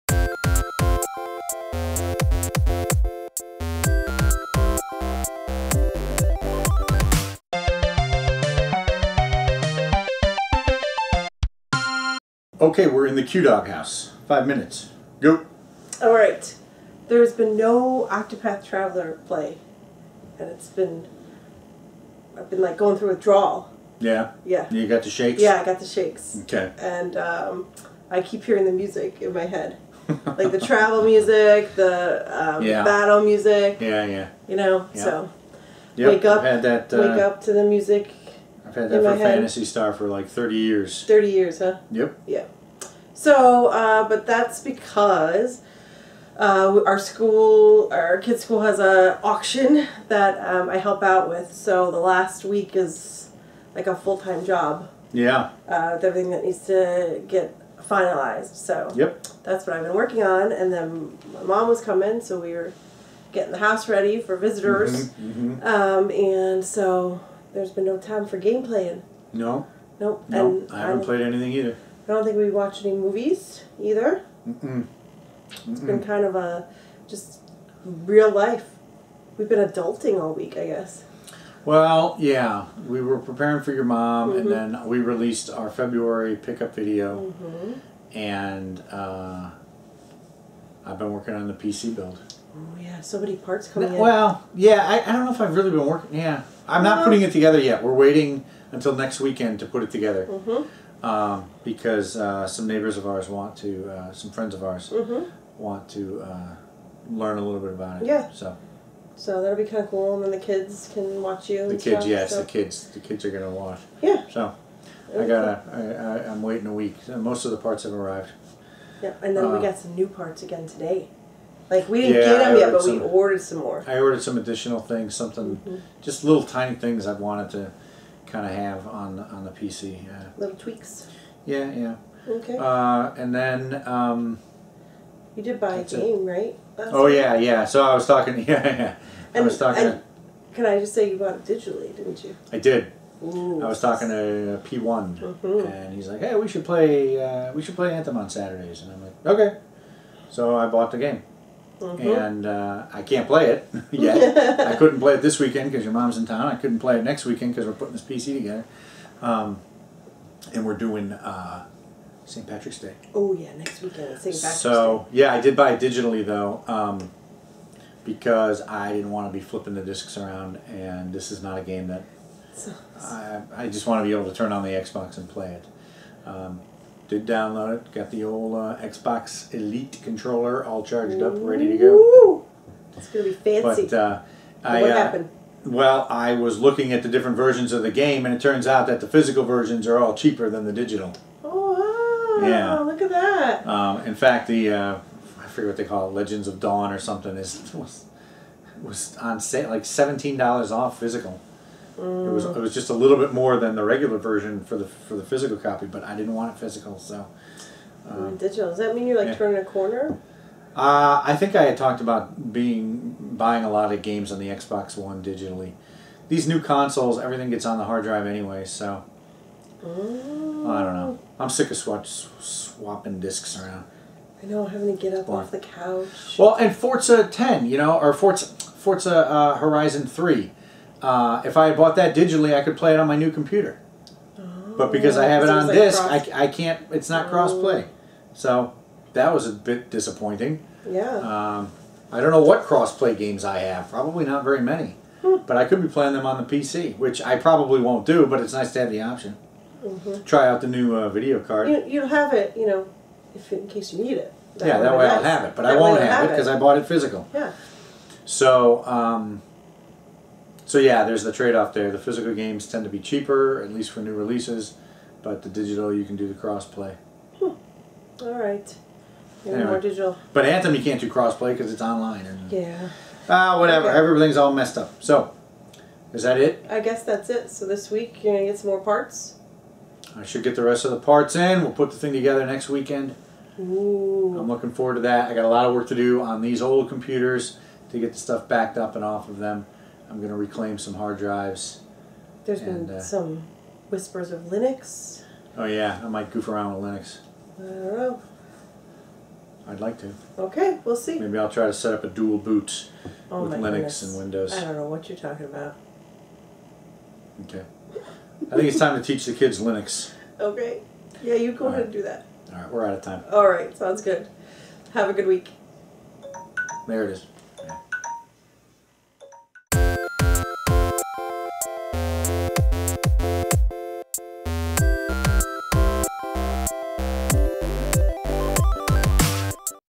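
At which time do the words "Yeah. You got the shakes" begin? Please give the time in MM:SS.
00:24.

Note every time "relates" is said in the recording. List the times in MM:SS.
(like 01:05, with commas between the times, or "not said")
not said.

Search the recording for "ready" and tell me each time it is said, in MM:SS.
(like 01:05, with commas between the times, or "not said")
01:03, 03:01.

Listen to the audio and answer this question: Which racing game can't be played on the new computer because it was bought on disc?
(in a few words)
Forza Horizon 3.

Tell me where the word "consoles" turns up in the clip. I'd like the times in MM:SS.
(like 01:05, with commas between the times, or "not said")
03:36.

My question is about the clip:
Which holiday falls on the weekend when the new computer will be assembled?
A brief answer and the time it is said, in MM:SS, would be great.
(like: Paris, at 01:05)
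St. Patrick's Day, at 02:42.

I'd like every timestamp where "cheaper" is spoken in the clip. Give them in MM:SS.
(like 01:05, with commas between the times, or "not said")
03:10, 04:22.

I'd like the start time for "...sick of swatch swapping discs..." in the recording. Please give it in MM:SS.
03:41.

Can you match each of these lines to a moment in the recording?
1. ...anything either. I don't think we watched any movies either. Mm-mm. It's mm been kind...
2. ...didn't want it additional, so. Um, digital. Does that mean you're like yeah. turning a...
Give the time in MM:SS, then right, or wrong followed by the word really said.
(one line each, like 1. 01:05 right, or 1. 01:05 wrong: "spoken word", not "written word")
1. 01:11 right
2. 03:26 wrong: "physical", not "additional".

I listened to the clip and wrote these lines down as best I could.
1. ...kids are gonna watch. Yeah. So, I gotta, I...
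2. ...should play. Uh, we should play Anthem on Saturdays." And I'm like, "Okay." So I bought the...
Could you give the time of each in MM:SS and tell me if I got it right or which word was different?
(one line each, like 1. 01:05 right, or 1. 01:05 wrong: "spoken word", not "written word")
1. 01:52 right
2. 02:26 right.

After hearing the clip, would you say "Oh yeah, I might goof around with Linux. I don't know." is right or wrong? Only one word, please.
right.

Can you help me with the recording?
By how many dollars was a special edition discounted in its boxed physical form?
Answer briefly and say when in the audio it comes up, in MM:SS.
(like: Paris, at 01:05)
17, at 03:19.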